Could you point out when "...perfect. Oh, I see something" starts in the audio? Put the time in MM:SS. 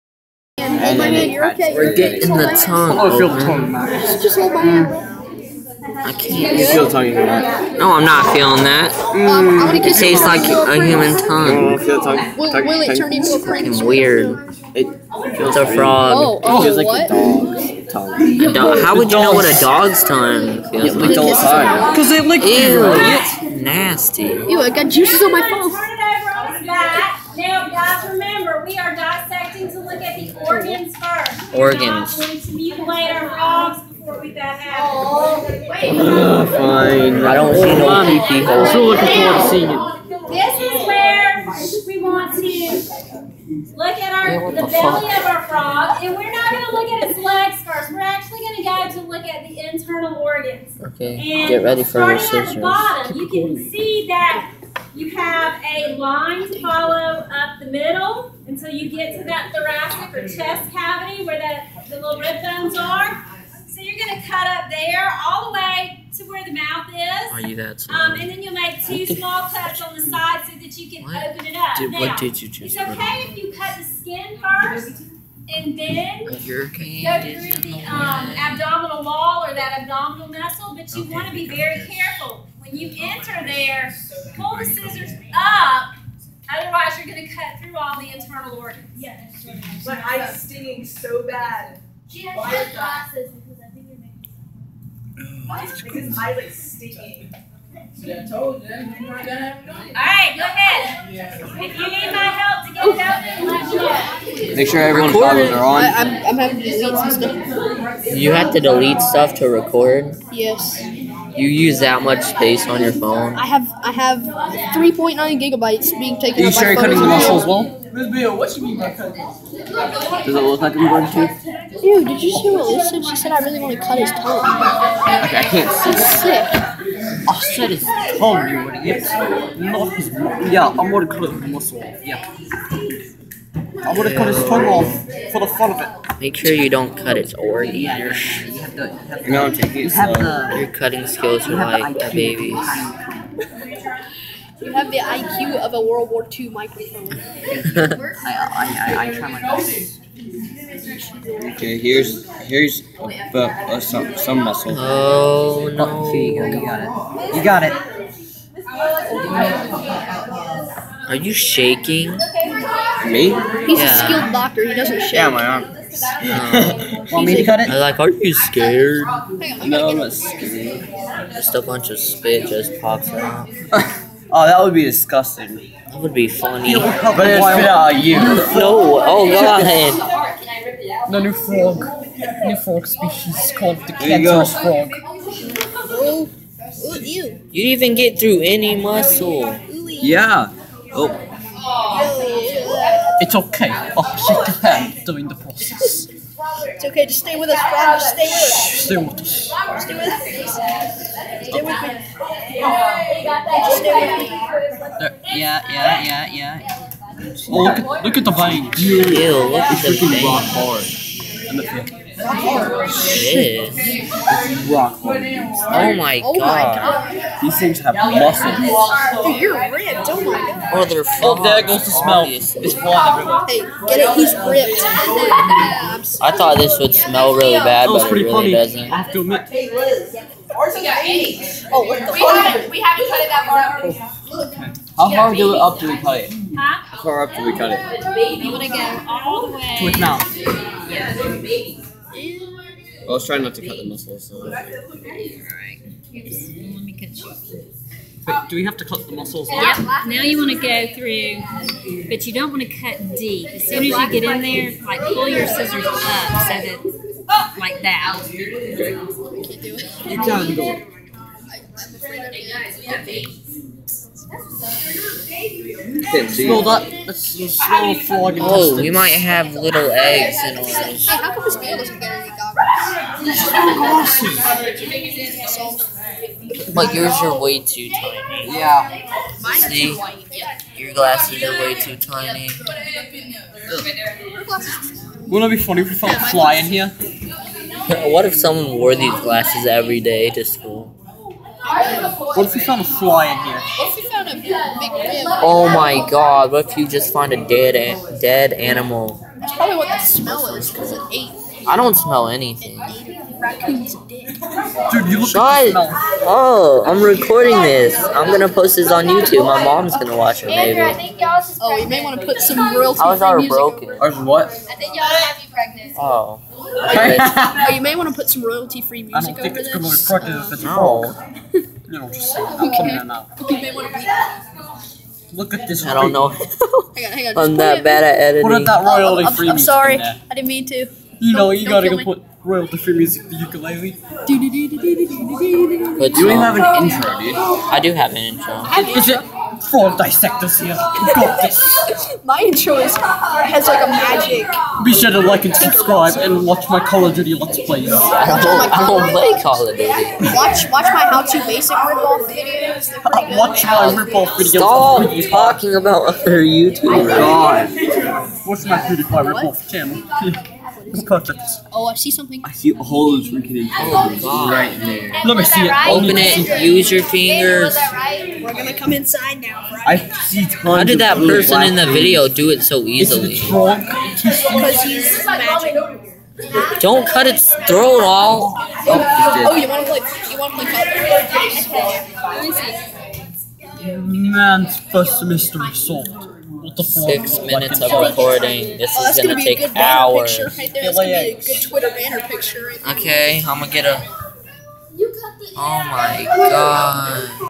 06:01.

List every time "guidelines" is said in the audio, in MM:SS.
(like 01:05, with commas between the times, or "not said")
not said.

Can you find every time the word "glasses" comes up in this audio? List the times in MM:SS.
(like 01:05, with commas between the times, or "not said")
01:32, 04:40, 04:49.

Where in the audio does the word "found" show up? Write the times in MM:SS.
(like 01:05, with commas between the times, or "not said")
04:45, 04:52.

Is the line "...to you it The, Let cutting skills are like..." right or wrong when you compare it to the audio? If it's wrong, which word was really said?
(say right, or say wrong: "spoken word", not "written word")
wrong: "Your", not "Let".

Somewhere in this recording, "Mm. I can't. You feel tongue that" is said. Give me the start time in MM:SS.
00:04.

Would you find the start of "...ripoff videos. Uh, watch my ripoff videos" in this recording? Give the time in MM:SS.
05:51.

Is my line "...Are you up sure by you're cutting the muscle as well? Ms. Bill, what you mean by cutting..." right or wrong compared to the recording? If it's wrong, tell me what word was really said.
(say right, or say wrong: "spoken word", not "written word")
right.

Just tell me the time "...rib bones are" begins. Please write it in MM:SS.
01:02.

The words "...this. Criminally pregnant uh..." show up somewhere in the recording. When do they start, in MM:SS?
05:19.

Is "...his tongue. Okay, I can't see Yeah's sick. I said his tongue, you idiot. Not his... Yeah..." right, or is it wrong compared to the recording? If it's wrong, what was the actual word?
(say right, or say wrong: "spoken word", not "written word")
wrong: "That", not "Yeah".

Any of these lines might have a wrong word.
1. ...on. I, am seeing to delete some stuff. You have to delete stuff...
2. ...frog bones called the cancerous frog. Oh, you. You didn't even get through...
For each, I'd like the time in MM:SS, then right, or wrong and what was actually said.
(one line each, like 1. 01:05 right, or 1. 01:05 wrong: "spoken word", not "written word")
1. 01:45 wrong: "having", not "seeing"
2. 03:02 wrong: "species", not "bones".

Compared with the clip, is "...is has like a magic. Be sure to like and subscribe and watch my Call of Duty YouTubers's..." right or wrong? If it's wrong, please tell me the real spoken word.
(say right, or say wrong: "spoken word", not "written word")
wrong: "Let", not "YouTubers".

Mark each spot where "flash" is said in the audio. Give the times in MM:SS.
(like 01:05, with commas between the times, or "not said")
not said.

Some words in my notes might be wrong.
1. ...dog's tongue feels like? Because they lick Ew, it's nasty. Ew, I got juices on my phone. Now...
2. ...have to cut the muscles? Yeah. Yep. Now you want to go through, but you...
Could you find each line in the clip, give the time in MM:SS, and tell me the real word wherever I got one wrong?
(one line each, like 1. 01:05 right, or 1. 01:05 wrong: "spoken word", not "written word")
1. 00:19 right
2. 04:08 right.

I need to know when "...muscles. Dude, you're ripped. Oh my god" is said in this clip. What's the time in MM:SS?
03:37.